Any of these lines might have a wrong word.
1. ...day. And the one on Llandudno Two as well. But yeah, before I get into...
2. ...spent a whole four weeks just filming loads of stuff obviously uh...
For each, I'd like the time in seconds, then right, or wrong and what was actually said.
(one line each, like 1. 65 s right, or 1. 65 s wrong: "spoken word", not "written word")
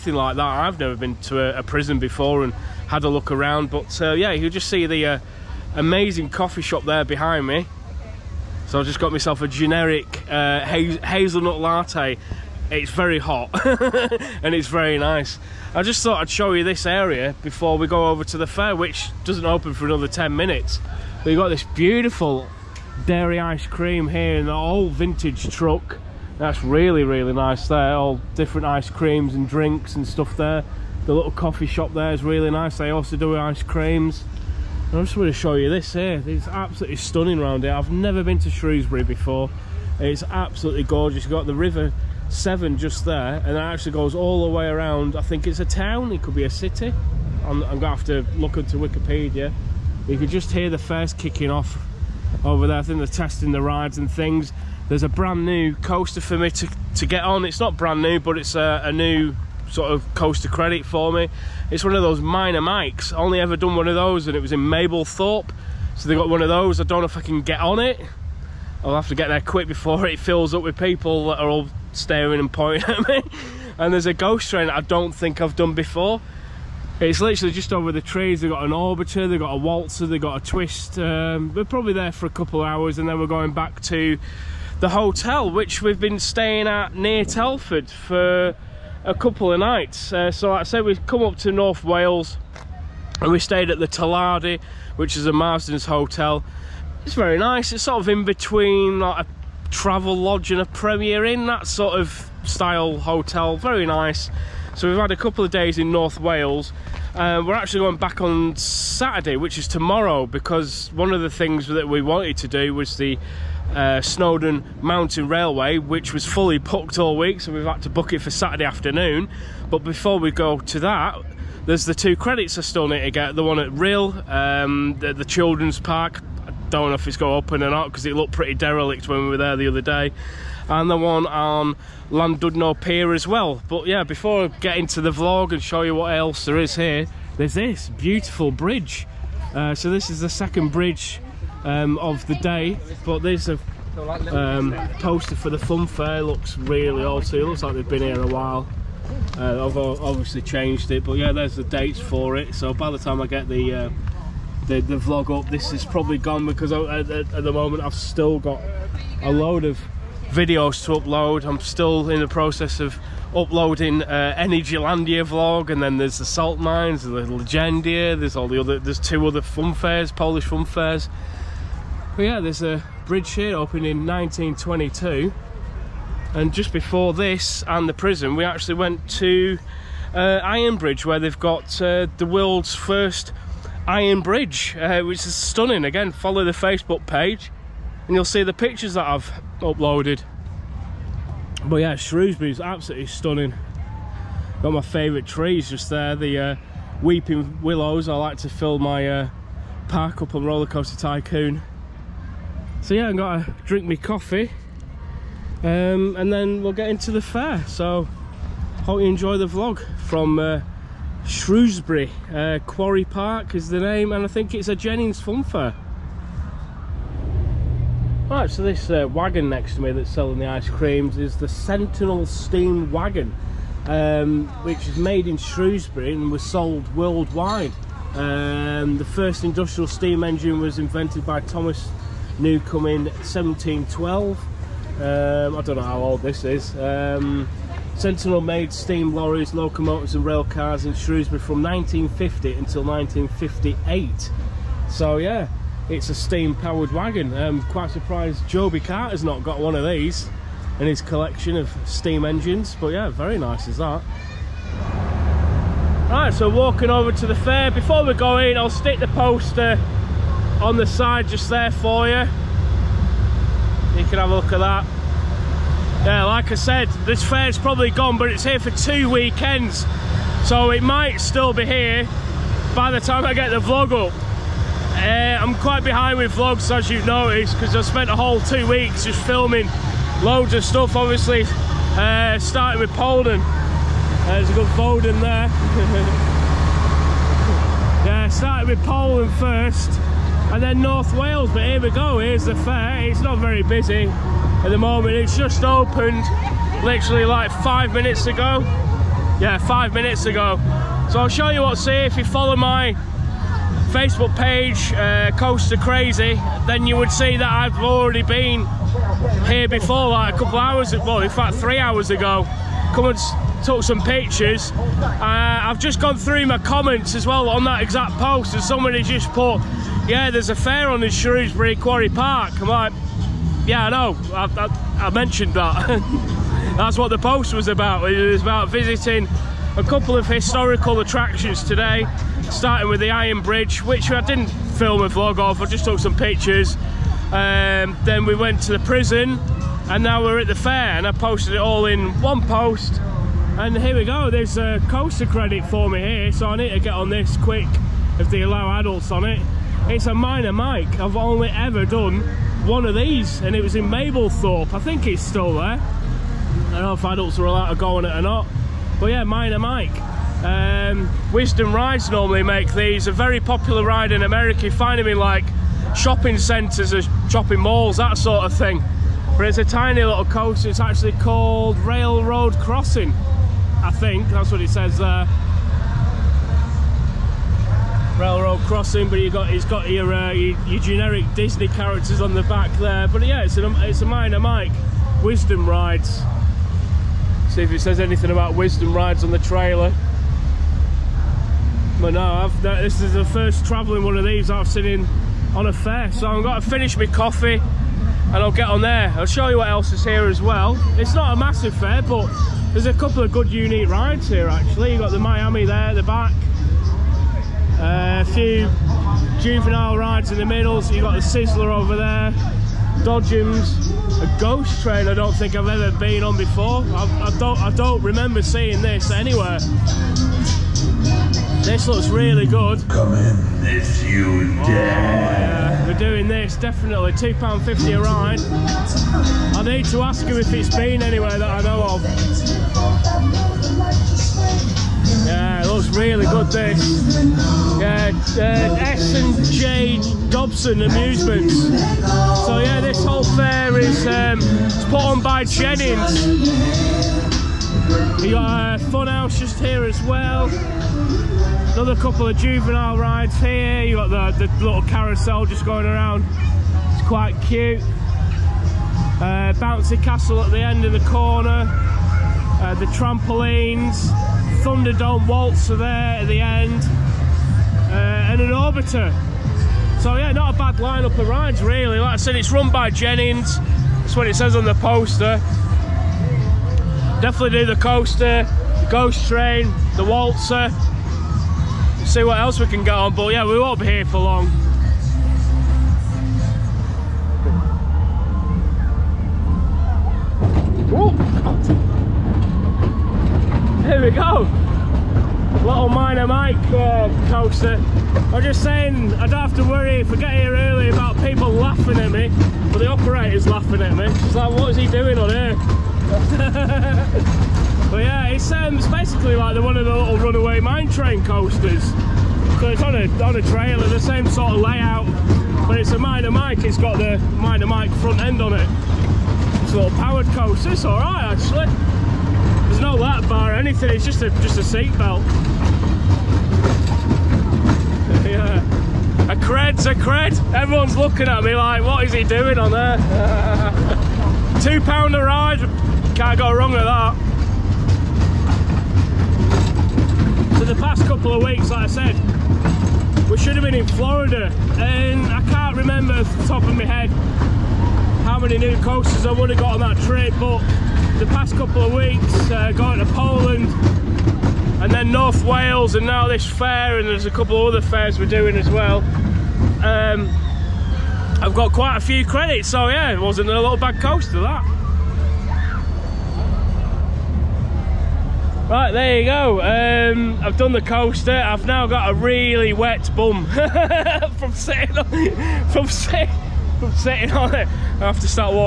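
1. 129 s wrong: "Pier", not "Two"
2. 277 s wrong: "two", not "four".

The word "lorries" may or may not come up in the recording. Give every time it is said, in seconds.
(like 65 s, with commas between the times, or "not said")
239 s.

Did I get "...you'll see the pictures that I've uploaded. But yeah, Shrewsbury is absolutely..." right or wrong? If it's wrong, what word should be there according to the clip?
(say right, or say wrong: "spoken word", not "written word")
right.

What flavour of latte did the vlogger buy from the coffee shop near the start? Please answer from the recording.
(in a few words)
Hazelnut.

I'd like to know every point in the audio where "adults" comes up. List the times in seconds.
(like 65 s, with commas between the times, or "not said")
348 s, 357 s.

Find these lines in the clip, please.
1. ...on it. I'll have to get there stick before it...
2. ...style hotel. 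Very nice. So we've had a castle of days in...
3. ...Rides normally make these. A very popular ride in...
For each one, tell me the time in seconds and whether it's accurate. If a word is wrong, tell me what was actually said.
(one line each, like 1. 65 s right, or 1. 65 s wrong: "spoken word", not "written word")
1. 67 s wrong: "quick", not "stick"
2. 102 s wrong: "couple", not "castle"
3. 361 s right.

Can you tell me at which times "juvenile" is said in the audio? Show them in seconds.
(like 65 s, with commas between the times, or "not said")
409 s, 452 s.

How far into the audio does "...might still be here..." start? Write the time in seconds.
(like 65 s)
270 s.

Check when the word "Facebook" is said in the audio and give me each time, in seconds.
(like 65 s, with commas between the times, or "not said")
186 s, 303 s.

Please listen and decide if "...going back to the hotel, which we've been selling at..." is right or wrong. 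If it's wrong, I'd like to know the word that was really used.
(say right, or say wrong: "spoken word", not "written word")
wrong: "staying", not "selling".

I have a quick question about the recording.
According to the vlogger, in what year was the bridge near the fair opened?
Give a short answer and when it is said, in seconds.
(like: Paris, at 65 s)
1922, at 174 s.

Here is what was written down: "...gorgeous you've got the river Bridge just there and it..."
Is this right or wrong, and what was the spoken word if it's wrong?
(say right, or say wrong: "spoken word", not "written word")
wrong: "Severn", not "Bridge".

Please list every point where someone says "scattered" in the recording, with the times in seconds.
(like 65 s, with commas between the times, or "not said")
not said.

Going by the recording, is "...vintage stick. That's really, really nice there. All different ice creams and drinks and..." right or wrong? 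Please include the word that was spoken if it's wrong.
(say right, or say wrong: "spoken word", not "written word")
wrong: "truck", not "stick".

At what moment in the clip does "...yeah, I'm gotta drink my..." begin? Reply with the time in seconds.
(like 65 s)
202 s.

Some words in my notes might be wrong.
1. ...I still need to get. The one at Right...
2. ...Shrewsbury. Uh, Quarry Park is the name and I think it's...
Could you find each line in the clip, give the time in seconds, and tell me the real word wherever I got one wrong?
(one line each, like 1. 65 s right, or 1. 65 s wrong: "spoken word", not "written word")
1. 122 s wrong: "Rhyl", not "Right"
2. 211 s right.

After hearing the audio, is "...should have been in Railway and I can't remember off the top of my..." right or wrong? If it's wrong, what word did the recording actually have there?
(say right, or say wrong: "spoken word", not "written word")
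wrong: "Florida", not "Railway".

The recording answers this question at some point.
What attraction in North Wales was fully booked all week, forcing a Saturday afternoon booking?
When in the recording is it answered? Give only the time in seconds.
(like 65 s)
114 s.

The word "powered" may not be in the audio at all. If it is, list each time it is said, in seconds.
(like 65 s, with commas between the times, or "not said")
246 s, 519 s.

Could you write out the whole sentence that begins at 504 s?
She's like, what is he doing on here?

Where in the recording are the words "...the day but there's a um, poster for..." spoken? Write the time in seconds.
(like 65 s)
142 s.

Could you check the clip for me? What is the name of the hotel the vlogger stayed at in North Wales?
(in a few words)
The Tallardy.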